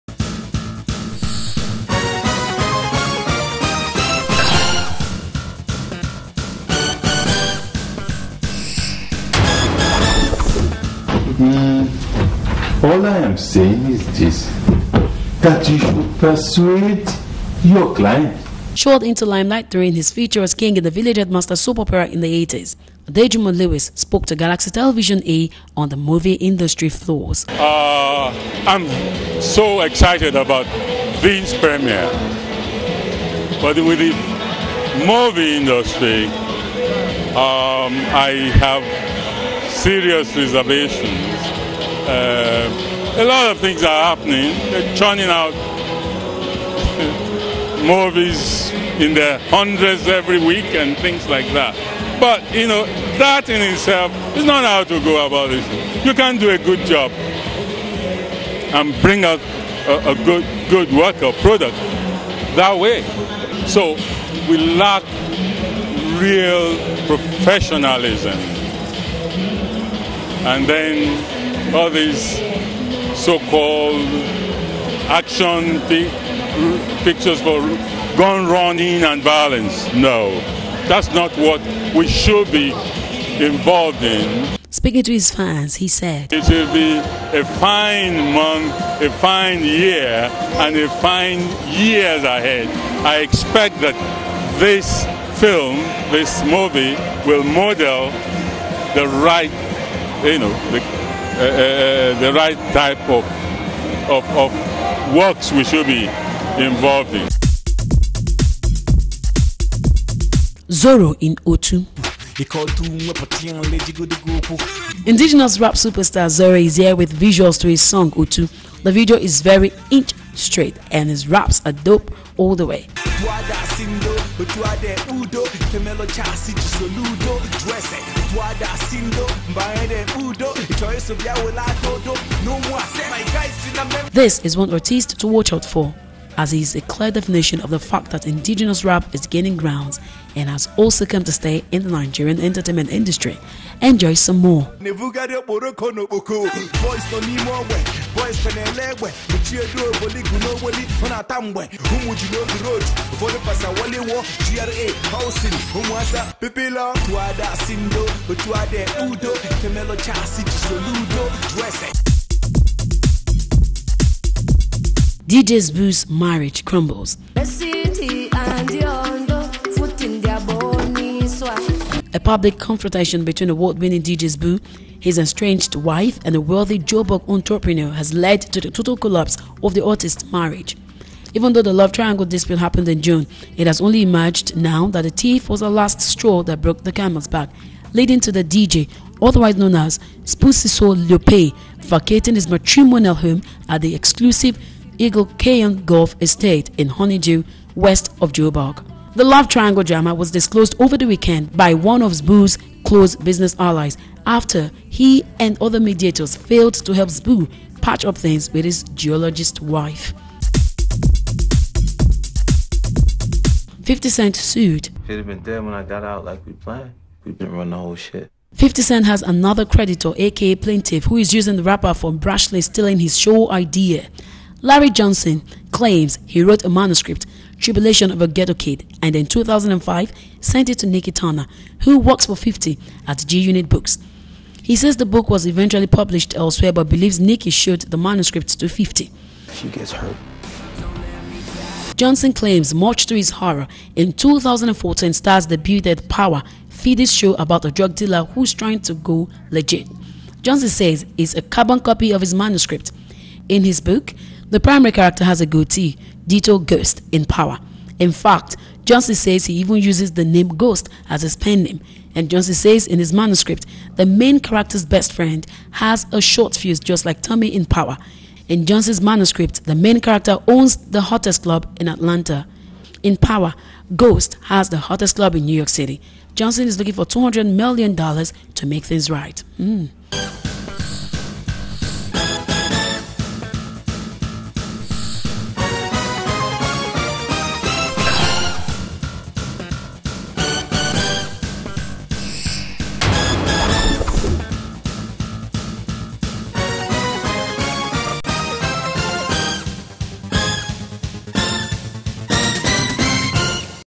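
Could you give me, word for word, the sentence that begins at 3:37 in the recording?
We've been running the whole shit.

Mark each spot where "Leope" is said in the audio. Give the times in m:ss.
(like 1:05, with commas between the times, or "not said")
3:11.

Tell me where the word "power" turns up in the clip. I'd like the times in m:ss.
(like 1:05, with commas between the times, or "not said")
4:06, 4:17, 4:27, 4:33.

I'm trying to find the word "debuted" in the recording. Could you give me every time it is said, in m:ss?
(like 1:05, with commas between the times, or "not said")
4:05.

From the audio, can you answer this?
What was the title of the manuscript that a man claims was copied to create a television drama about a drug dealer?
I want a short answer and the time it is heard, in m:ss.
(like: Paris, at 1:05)
Tribulation of a Ghetto Kid, at 3:47.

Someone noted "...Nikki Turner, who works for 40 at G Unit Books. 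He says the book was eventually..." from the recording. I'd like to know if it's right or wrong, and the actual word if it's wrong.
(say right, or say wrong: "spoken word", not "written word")
wrong: "50", not "40".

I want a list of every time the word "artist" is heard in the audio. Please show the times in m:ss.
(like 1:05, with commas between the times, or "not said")
2:14, 2:59.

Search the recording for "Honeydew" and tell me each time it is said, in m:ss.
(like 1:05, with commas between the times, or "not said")
3:16.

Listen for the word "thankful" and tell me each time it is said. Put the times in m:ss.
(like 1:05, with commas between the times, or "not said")
not said.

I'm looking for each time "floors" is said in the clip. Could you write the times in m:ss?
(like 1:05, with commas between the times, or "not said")
0:26.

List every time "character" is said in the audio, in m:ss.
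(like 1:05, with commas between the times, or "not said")
4:14, 4:24, 4:30.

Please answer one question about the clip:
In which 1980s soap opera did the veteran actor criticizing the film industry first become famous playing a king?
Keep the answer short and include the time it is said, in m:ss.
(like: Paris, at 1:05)
Village Headmaster, at 0:20.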